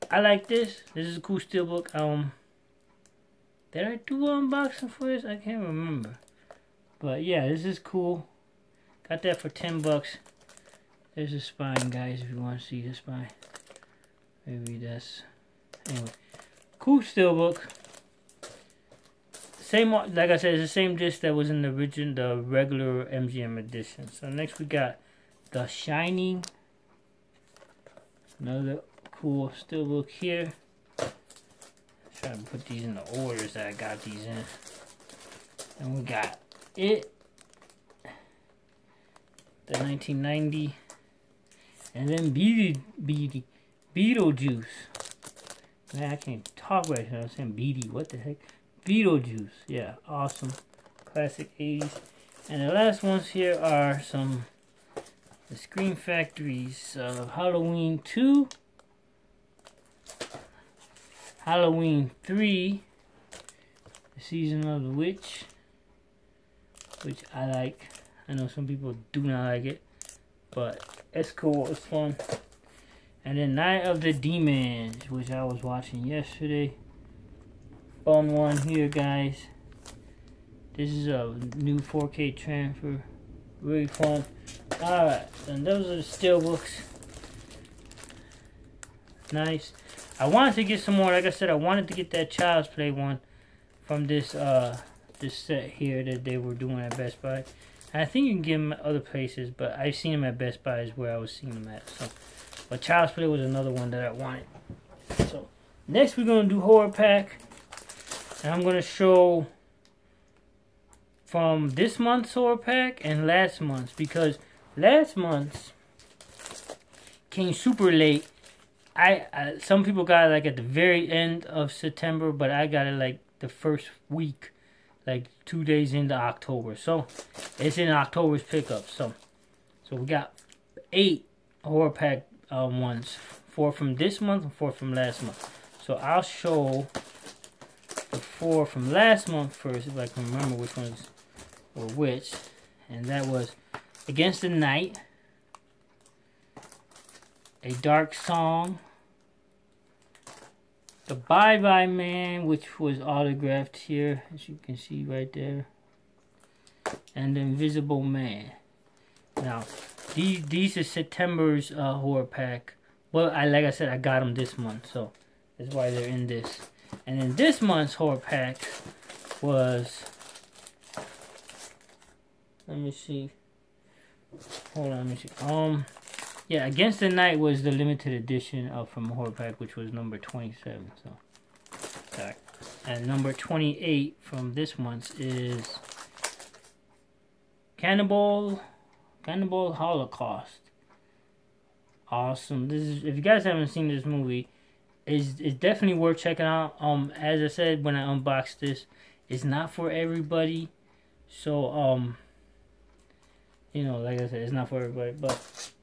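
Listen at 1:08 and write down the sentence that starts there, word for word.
I know some people do not like it, but it's cool.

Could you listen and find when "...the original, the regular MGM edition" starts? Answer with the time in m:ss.
0:21.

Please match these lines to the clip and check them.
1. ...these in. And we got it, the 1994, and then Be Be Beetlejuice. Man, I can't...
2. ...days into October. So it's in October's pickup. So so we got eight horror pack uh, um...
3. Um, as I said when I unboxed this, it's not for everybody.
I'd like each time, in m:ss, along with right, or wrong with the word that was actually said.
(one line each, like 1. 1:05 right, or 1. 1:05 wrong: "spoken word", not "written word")
1. 0:34 wrong: "1990", not "1994"
2. 2:05 right
3. 3:16 right.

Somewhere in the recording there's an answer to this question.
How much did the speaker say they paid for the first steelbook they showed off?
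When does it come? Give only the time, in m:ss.
0:09.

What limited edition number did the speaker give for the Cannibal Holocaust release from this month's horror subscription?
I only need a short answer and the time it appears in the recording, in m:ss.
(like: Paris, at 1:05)
28, at 3:03.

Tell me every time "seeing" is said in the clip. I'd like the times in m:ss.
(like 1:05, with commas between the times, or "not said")
1:41.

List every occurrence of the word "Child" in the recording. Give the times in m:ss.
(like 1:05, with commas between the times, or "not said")
1:32, 1:42.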